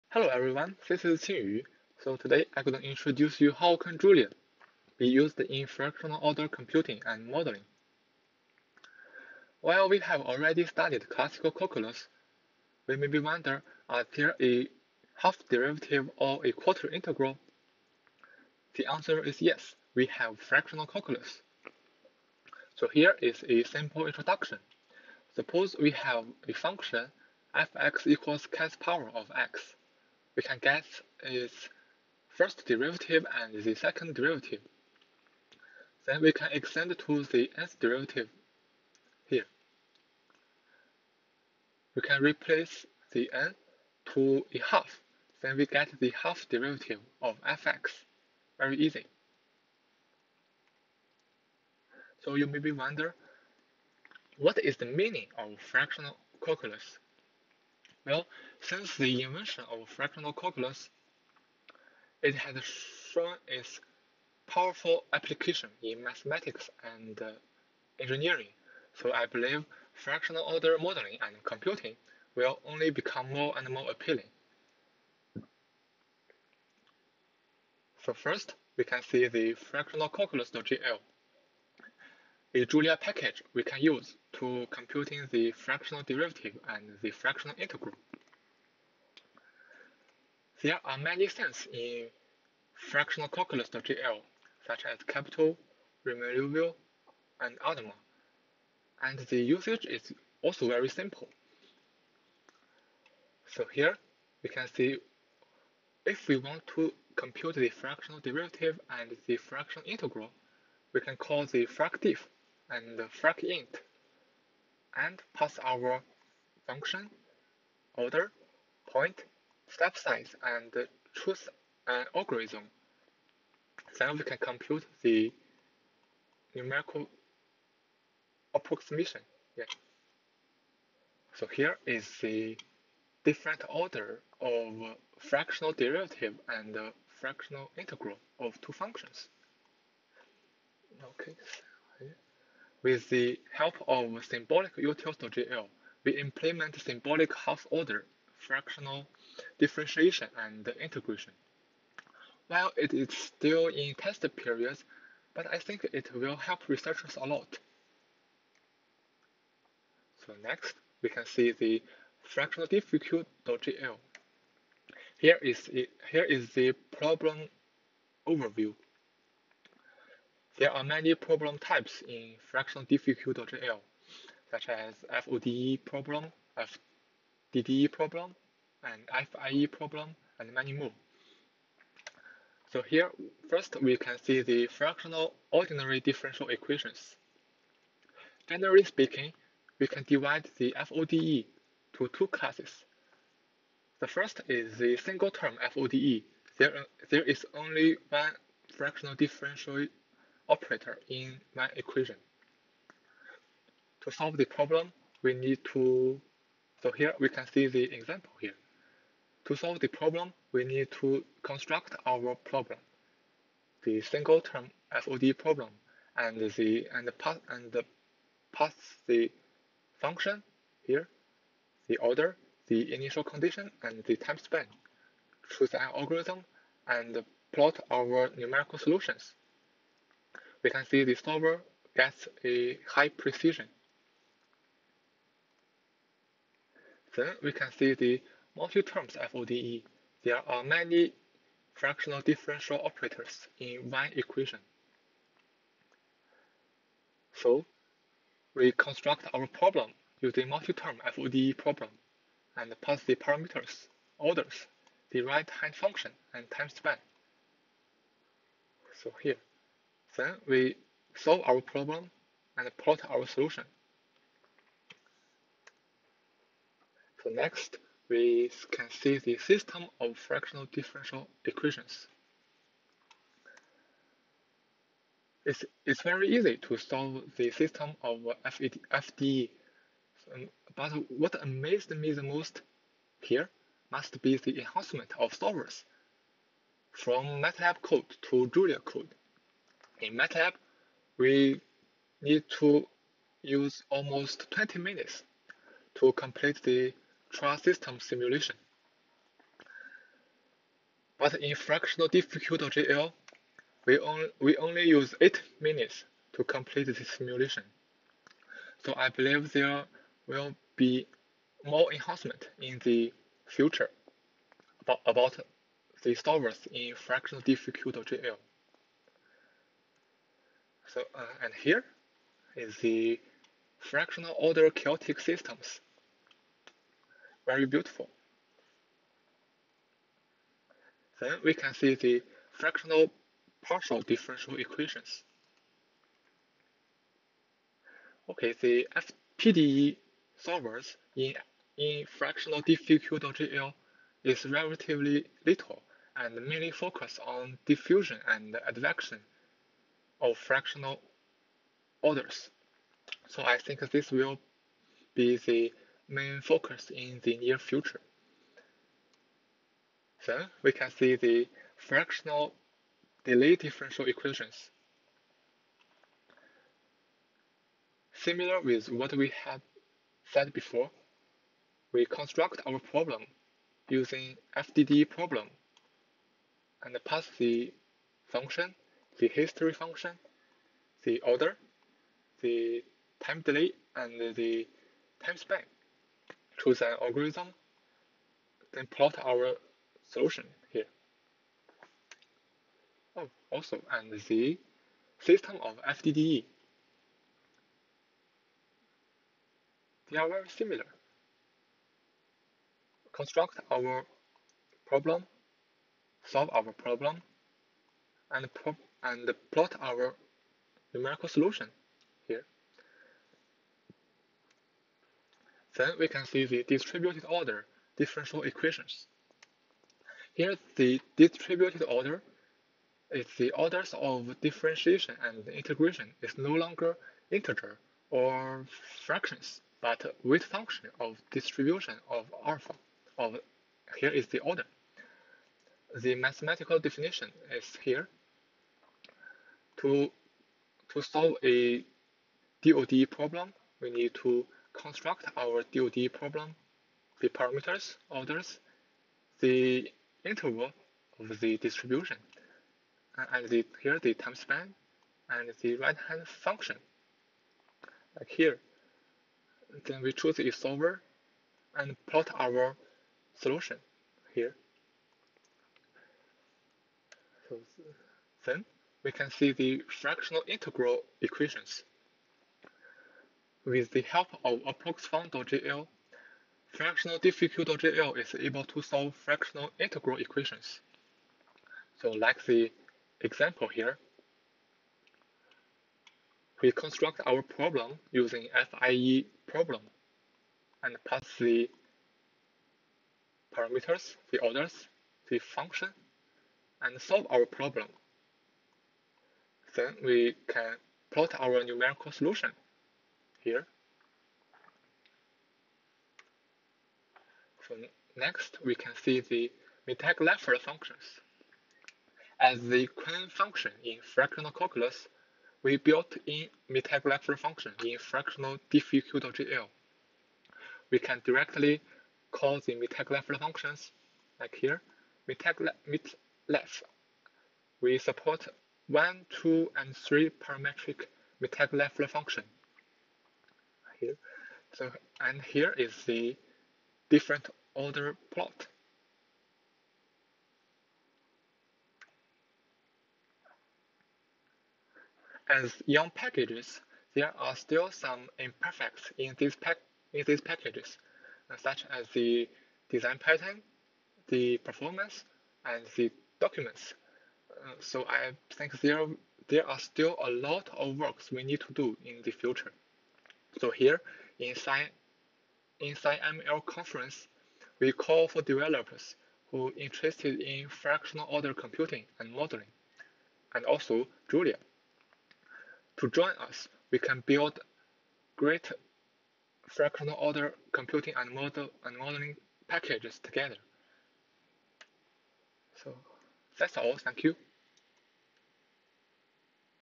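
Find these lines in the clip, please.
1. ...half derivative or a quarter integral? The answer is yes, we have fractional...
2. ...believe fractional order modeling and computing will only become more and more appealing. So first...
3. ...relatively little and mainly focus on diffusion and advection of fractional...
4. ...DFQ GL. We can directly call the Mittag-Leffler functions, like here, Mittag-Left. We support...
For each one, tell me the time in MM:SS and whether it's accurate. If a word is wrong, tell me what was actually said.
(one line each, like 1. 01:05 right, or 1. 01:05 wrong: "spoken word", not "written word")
1. 00:15 right
2. 01:09 right
3. 05:44 right
4. 08:38 right.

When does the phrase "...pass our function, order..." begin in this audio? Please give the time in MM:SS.
01:55.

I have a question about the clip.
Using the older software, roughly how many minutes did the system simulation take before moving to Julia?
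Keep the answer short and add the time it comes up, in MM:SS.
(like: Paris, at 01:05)
20, at 04:54.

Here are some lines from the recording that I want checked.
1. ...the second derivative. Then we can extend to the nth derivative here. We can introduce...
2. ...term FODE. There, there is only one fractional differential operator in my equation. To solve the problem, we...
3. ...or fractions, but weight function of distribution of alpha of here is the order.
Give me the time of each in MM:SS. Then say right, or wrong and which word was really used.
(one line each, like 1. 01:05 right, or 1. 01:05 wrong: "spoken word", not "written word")
1. 00:33 wrong: "replace", not "introduce"
2. 03:15 right
3. 07:08 right.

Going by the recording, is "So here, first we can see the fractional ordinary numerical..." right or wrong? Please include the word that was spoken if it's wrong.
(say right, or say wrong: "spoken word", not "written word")
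wrong: "differential", not "numerical".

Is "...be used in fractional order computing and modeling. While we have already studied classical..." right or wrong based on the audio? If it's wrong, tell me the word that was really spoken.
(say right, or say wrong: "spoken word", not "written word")
right.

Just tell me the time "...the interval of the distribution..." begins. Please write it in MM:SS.
07:29.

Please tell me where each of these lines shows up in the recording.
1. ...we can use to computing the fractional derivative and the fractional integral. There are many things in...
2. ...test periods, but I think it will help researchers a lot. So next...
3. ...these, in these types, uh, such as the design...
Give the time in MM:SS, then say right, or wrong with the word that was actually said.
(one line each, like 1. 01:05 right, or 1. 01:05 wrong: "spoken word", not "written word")
1. 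01:23 right
2. 02:33 right
3. 09:09 wrong: "packages", not "types".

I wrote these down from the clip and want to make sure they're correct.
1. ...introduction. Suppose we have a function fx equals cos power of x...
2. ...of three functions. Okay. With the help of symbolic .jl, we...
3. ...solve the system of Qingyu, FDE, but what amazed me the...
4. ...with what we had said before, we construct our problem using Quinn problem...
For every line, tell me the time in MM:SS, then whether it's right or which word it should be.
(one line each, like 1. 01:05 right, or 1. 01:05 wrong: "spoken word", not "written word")
1. 00:24 right
2. 02:18 wrong: "two", not "three"
3. 04:36 wrong: "FED", not "Qingyu"
4. 06:08 wrong: "FDD", not "Quinn".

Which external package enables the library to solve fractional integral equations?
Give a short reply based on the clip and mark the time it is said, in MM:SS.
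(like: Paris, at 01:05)
ApproxFun.jl, at 07:54.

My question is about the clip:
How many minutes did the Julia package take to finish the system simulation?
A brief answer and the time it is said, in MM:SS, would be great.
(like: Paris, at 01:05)
8, at 05:05.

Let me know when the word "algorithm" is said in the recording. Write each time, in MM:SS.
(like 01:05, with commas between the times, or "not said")
02:02, 03:45, 06:27.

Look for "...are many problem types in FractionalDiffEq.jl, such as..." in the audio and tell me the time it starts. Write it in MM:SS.
02:50.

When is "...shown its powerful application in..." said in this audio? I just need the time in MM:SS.
01:02.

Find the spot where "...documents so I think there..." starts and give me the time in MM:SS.
09:16.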